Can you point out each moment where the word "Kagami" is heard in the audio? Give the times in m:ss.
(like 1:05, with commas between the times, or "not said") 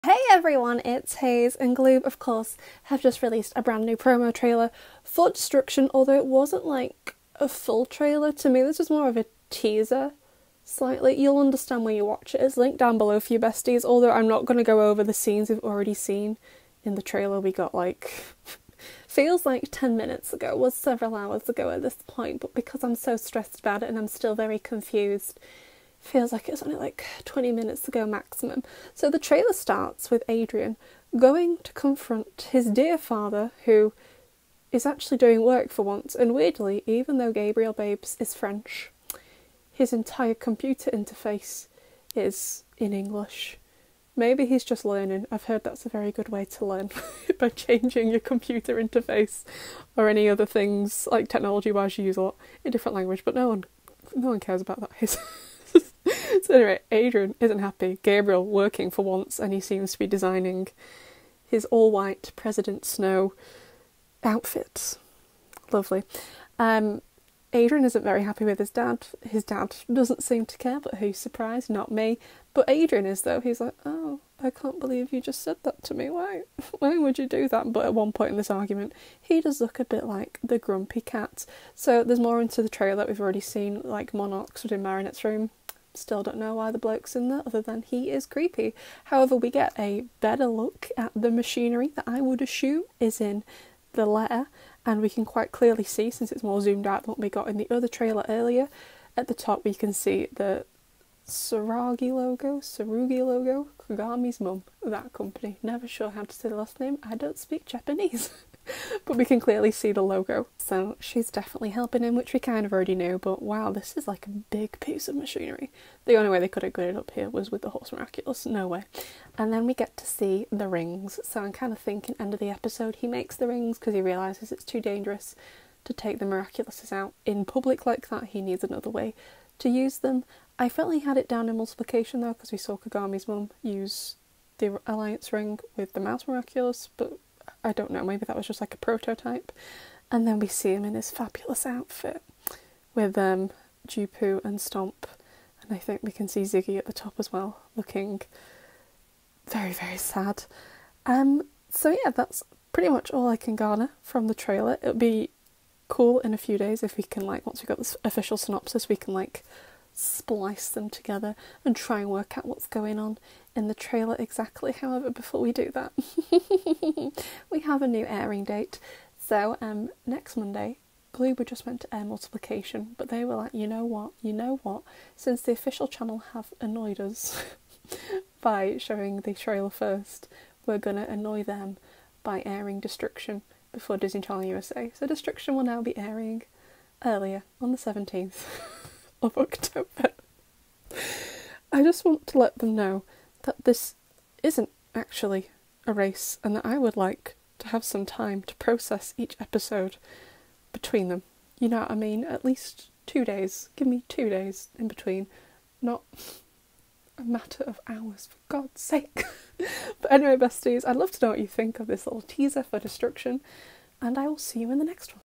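1:43, 2:12.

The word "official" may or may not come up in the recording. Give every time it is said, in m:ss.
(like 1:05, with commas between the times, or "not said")
2:38, 2:55.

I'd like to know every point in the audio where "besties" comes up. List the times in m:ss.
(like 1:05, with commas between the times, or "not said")
0:13, 3:30.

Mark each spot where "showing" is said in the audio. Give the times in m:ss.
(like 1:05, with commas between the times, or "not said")
2:58.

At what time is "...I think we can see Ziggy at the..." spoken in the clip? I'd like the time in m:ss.
2:25.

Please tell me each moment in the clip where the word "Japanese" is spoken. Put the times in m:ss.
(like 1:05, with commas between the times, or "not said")
1:47.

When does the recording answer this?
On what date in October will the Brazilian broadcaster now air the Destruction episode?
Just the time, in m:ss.
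3:07.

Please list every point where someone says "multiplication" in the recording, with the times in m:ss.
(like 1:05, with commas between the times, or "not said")
2:11, 2:52.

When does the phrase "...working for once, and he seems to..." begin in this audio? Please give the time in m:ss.
0:58.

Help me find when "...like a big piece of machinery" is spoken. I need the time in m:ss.
1:54.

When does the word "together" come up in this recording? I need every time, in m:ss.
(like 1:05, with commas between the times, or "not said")
2:40.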